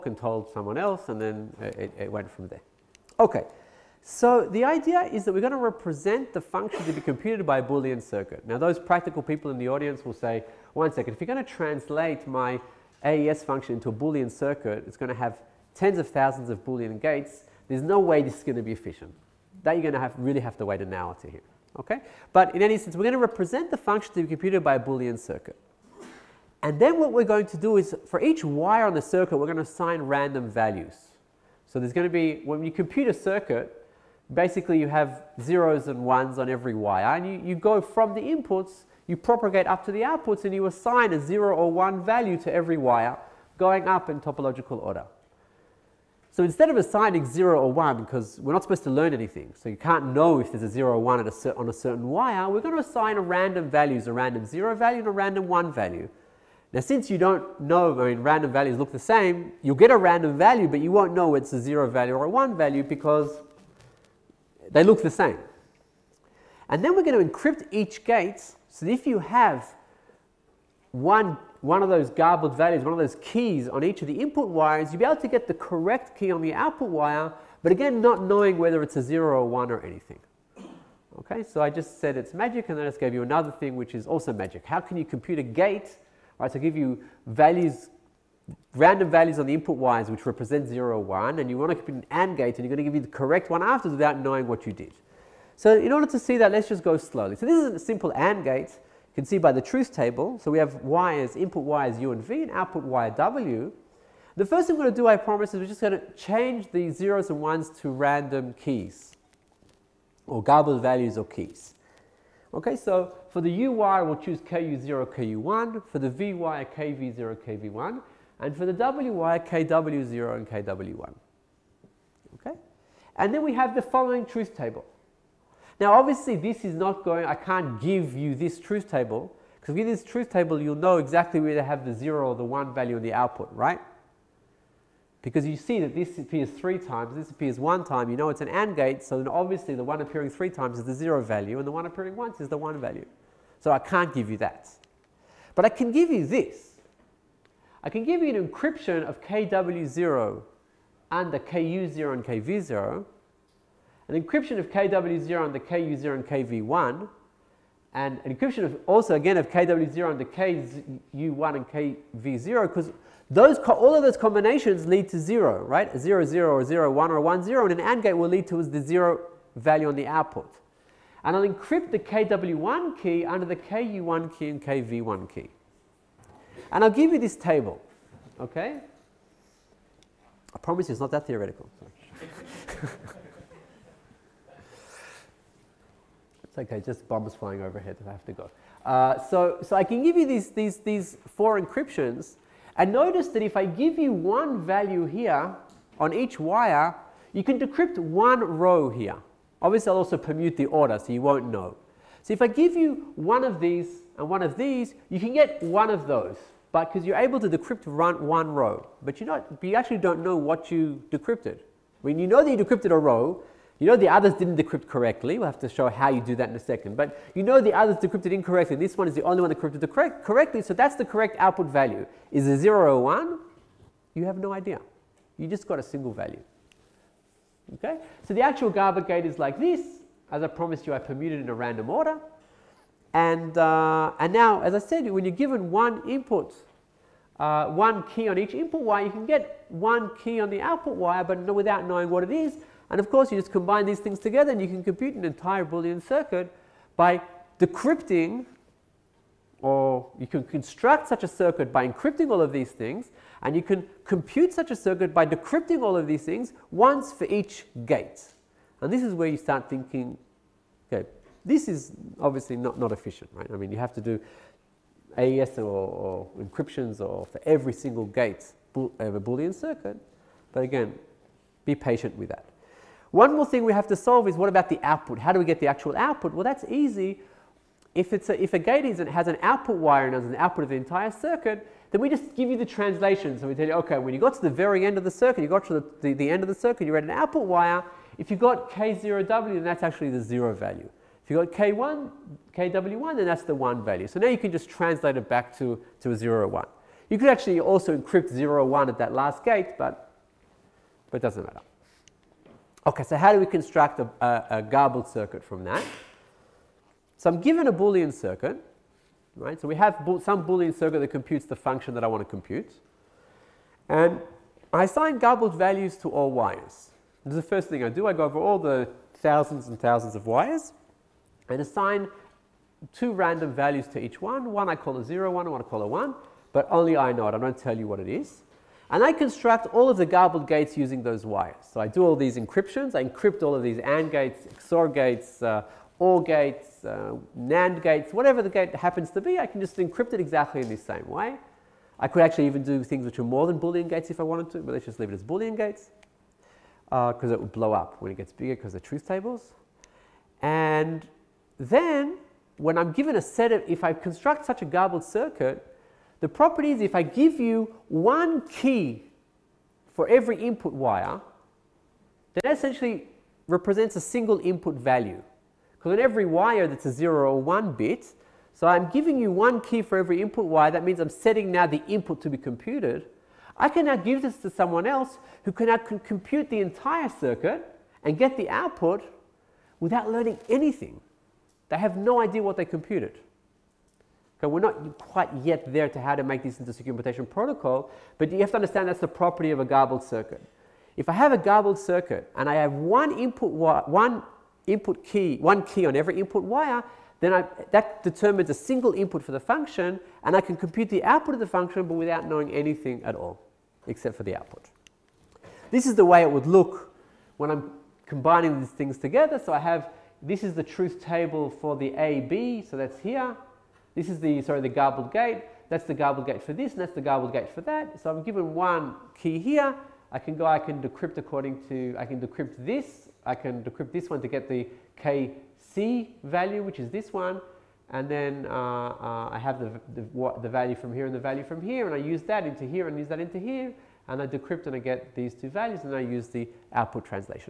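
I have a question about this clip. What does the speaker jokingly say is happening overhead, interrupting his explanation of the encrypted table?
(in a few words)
bombs flying.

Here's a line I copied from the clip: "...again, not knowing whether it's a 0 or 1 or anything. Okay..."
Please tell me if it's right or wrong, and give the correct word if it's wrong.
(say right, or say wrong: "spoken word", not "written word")
right.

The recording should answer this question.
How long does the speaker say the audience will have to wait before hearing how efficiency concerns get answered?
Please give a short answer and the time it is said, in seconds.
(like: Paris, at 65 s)
an hour, at 20 s.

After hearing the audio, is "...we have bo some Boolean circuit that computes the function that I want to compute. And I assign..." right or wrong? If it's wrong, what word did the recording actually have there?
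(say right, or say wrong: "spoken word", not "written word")
right.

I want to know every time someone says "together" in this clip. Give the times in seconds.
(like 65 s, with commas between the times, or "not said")
244 s, 408 s.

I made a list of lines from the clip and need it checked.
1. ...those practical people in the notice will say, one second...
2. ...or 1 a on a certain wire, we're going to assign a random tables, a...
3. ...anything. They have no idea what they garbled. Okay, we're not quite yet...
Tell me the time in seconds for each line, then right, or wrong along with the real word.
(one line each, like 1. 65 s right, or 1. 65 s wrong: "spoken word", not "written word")
1. 8 s wrong: "audience", not "notice"
2. 50 s wrong: "values", not "tables"
3. 380 s wrong: "computed", not "garbled".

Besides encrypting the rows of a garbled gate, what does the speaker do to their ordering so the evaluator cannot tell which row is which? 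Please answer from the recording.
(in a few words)
permute the order.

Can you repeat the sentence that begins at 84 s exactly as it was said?
How can you compute a gate?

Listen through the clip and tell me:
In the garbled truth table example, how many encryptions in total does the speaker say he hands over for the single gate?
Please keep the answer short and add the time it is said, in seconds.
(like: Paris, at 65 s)
4, at 191 s.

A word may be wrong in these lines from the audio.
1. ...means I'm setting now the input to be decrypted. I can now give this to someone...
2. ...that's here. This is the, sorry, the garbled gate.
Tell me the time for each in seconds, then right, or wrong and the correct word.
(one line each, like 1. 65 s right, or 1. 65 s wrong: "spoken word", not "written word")
1. 370 s wrong: "computed", not "decrypted"
2. 412 s right.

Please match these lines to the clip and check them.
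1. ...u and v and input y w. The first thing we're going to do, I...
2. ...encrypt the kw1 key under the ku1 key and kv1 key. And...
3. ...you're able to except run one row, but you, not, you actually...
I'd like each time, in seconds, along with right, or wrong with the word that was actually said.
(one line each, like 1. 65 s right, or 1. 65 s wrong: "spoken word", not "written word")
1. 101 s wrong: "output", not "input"
2. 171 s right
3. 207 s wrong: "decrypt", not "except".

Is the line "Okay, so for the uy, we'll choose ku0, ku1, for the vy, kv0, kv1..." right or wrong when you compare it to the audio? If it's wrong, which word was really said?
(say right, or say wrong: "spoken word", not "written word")
right.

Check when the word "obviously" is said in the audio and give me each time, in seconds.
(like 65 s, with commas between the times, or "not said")
125 s, 139 s, 199 s, 262 s.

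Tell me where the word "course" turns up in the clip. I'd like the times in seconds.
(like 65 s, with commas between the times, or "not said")
243 s.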